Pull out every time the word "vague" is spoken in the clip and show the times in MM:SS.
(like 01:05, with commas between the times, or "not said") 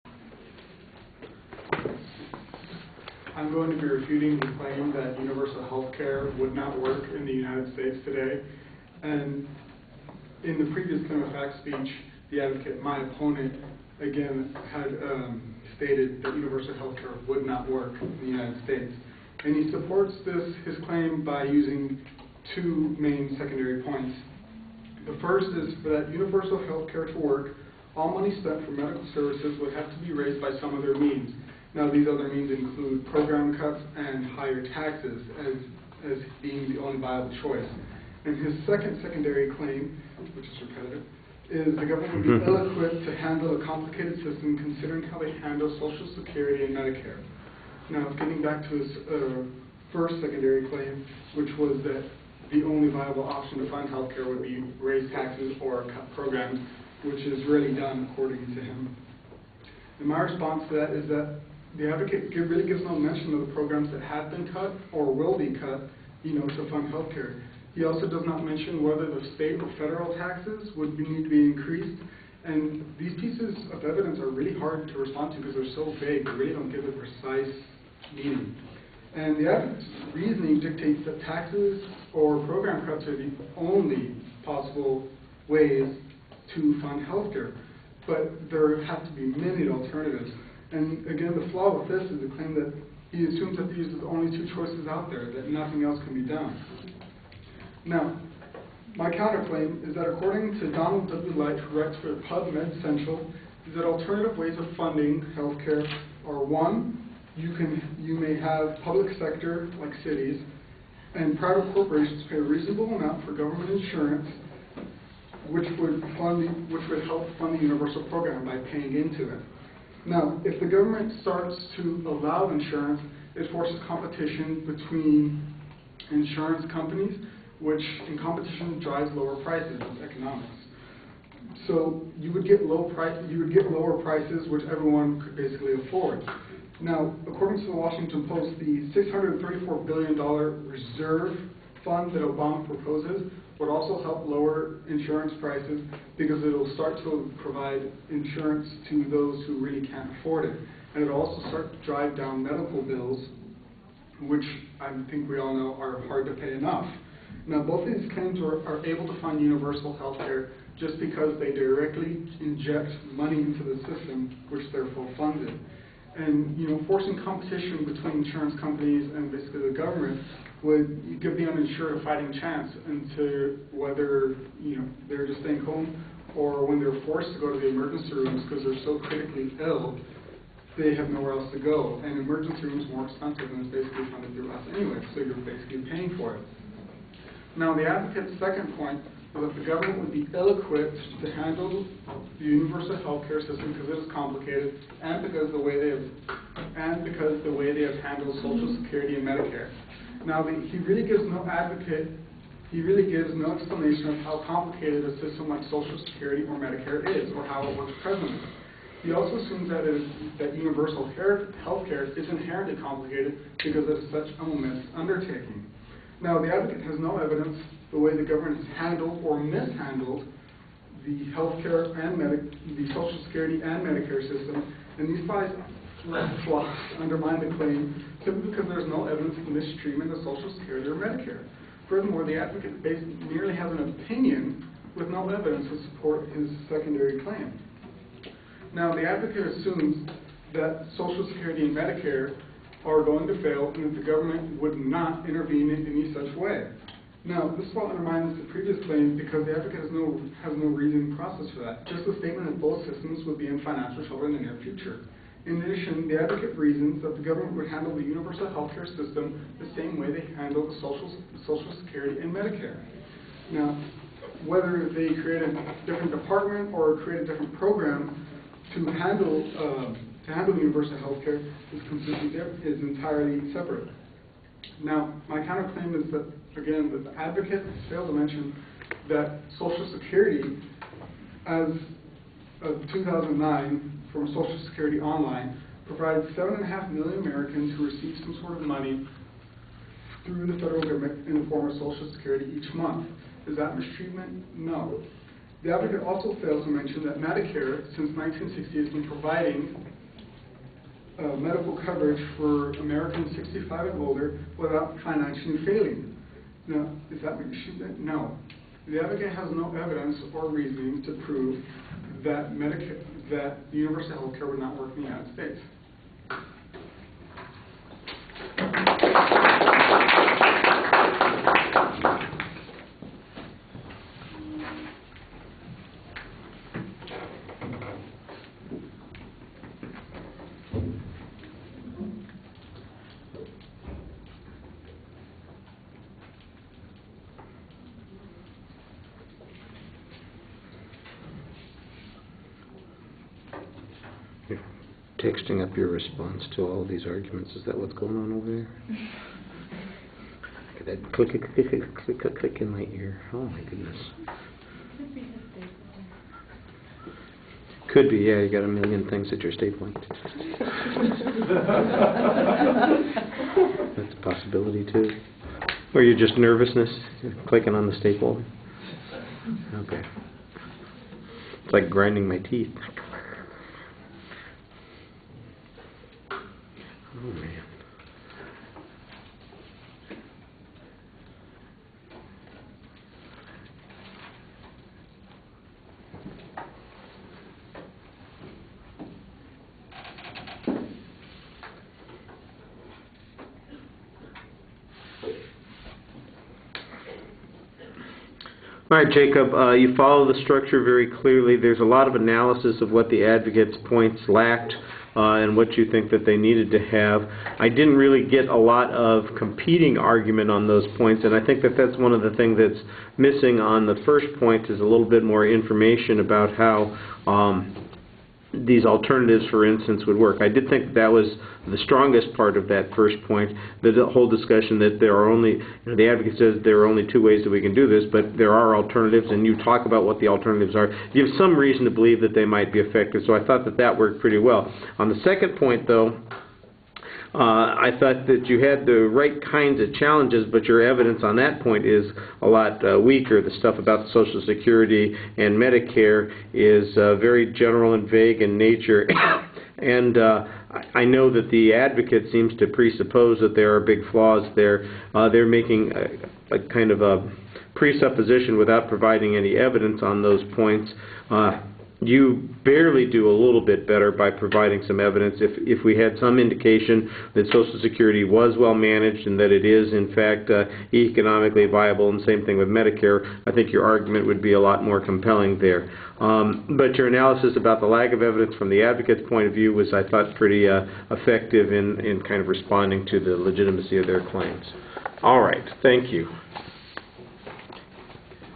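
01:16, 07:28.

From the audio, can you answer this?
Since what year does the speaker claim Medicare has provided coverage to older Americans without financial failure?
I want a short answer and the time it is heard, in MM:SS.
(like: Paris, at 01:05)
1960, at 04:58.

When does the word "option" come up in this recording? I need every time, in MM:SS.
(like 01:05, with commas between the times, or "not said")
00:53.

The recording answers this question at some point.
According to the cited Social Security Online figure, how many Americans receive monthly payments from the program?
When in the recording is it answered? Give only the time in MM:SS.
04:46.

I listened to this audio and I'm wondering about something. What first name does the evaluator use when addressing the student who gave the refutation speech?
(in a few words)
Jacob.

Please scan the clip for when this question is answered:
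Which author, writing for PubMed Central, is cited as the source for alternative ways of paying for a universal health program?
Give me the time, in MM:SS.
01:40.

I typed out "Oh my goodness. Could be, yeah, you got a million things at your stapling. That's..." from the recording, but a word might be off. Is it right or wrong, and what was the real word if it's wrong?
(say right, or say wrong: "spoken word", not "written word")
right.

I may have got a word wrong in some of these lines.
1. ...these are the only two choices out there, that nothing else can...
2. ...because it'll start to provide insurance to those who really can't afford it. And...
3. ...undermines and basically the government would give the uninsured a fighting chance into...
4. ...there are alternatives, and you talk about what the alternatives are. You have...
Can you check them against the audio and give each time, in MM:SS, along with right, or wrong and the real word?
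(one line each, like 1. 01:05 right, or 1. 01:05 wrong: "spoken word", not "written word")
1. 01:33 right
2. 02:26 right
3. 02:48 wrong: "companies", not "undermines"
4. 07:08 right.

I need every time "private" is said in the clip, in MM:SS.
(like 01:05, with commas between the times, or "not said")
01:51.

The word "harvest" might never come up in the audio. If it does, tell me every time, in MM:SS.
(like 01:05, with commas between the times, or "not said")
not said.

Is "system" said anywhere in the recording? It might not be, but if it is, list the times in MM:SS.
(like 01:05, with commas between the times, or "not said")
00:44, 02:43, 03:13, 03:25, 03:44, 04:12, 04:18.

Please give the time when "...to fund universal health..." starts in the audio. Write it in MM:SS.
02:39.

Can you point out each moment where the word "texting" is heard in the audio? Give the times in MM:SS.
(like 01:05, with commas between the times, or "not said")
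05:45.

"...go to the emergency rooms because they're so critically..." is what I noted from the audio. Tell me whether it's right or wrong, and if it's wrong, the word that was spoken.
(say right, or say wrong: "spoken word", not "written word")
right.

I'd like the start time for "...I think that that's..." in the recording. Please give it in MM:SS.
06:51.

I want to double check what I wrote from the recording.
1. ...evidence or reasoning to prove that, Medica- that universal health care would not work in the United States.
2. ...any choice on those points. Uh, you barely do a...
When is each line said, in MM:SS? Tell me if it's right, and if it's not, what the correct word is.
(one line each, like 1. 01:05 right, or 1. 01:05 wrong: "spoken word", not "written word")
1. 05:09 right
2. 07:39 wrong: "evidence", not "choice".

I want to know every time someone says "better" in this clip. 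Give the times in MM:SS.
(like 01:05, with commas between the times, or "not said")
07:43.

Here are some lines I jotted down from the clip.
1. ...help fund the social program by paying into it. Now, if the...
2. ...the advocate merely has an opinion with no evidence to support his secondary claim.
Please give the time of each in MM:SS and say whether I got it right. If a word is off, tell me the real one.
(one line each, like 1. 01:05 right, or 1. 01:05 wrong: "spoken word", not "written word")
1. 01:57 wrong: "universal", not "social"
2. 03:52 right.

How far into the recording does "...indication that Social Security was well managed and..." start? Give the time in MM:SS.
07:46.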